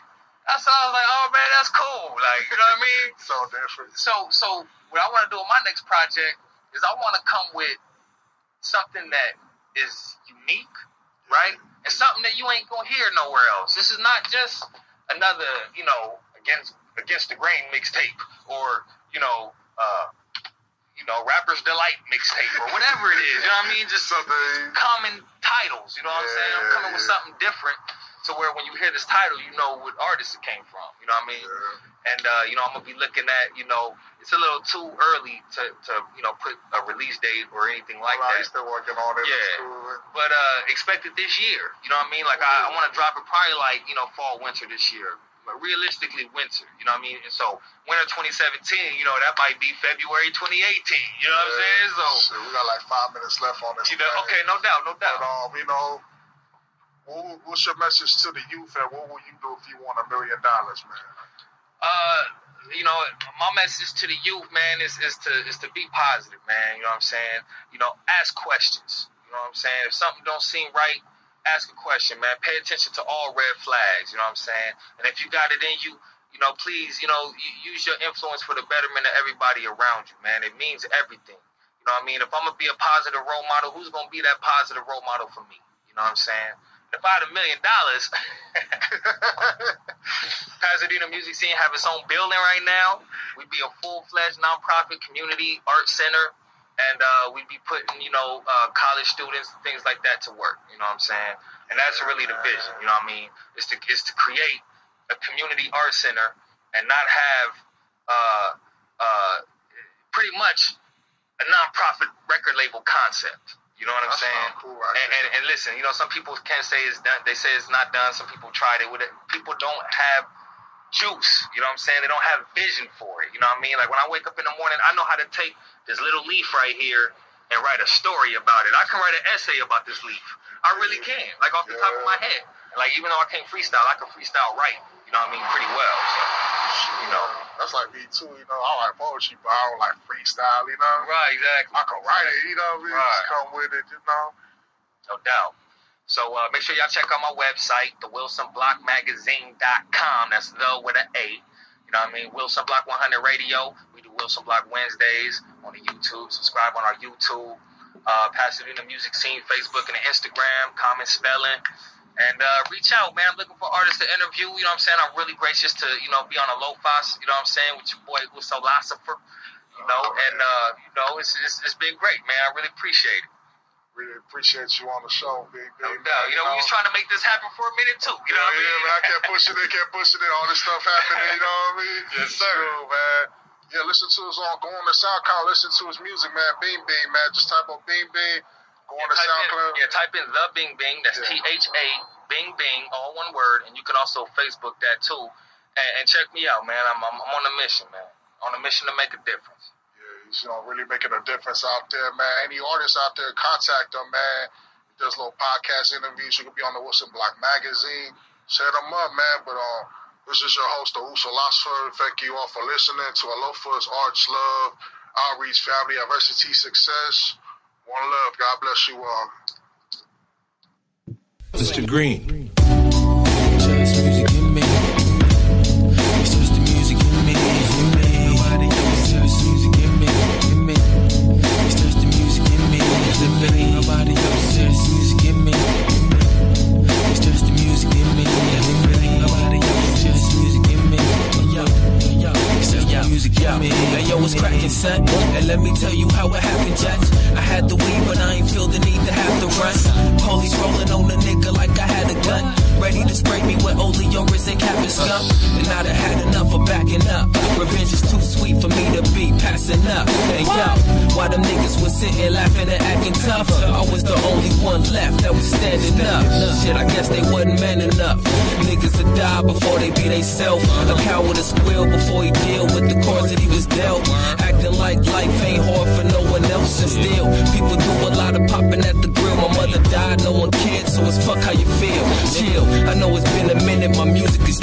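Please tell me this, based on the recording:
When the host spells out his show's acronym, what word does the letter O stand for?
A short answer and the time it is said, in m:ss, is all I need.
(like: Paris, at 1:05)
Outreach, at 3:35.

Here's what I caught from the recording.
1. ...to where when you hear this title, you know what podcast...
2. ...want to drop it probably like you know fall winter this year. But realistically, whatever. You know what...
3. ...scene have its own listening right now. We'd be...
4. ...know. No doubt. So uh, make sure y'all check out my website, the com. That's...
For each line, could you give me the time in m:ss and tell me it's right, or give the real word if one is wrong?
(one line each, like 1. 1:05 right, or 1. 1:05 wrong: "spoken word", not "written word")
1. 0:28 wrong: "artist", not "podcast"
2. 0:42 wrong: "winter", not "whatever"
3. 1:31 wrong: "building", not "listening"
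4. 2:24 right.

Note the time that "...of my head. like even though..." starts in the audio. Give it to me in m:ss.
2:12.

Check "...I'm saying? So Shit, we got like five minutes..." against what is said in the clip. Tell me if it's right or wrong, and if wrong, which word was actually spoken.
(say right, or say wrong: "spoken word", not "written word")
right.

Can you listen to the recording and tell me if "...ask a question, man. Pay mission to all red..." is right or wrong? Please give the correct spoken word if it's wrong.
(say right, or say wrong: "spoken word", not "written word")
wrong: "attention", not "mission".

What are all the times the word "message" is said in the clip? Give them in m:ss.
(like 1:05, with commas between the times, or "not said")
0:57, 1:03.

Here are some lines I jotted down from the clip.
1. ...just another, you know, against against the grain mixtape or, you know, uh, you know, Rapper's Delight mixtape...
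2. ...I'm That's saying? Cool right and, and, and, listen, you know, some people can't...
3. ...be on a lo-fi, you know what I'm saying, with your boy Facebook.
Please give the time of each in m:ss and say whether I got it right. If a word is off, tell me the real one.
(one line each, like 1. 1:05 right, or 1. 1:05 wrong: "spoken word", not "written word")
1. 0:14 right
2. 1:54 right
3. 2:46 wrong: "Usolosopher", not "Facebook".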